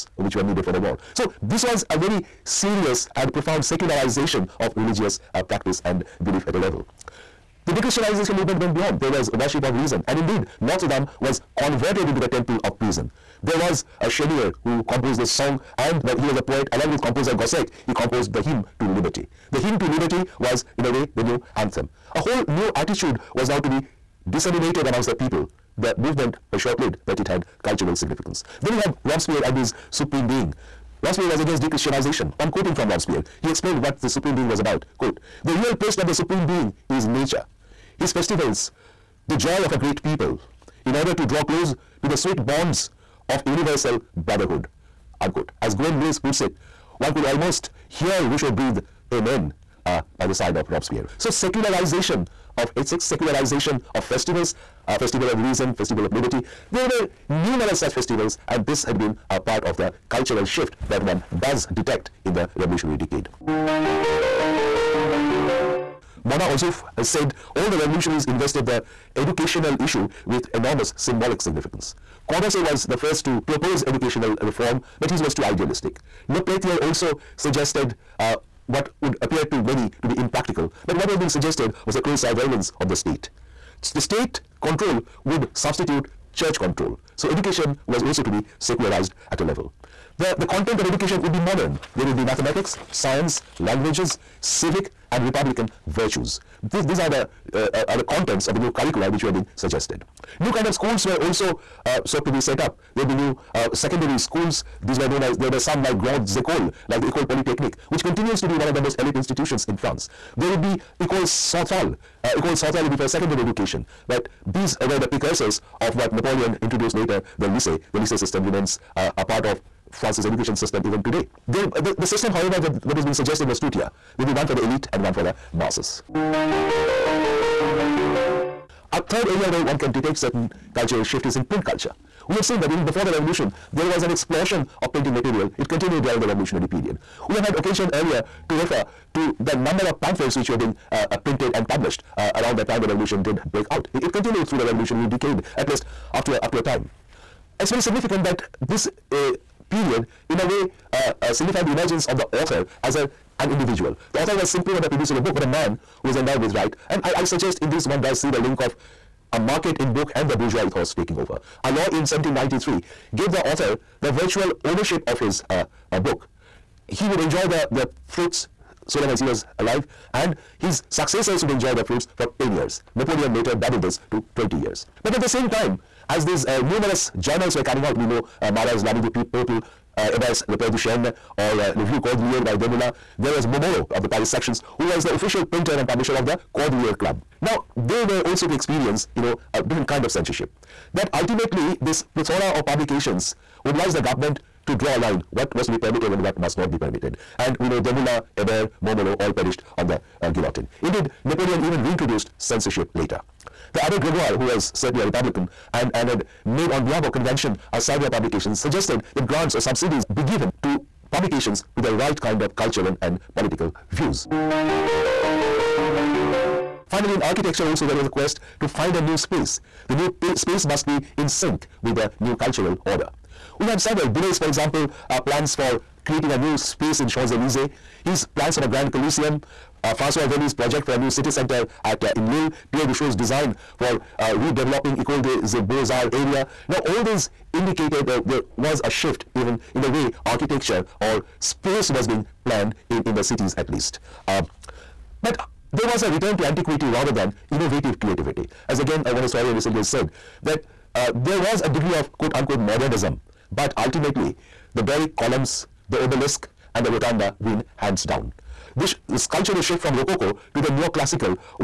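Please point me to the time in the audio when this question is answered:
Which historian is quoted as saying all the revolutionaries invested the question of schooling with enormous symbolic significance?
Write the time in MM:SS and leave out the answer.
01:06.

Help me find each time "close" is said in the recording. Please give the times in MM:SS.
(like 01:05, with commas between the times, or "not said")
00:41, 01:21.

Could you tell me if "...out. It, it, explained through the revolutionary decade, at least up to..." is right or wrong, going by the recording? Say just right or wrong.
wrong.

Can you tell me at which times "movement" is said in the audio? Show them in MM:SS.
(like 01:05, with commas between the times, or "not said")
00:08, 00:25.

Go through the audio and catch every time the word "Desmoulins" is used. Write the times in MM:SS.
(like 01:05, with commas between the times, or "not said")
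03:02, 03:17.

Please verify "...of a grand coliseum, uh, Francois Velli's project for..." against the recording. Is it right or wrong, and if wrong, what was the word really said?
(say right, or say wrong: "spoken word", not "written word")
right.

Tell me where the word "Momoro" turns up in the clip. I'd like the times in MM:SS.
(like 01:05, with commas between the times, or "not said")
03:03, 03:18.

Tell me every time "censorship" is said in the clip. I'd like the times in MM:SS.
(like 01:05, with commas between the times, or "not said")
03:10, 03:22.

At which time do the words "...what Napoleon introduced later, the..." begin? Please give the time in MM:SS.
01:55.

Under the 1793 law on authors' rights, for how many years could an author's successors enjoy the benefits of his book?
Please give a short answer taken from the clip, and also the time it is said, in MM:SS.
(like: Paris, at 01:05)
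10, at 02:52.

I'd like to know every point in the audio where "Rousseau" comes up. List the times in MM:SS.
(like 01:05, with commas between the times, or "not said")
00:48, 03:52.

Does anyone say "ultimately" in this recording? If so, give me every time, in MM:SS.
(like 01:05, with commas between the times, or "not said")
03:11, 04:13.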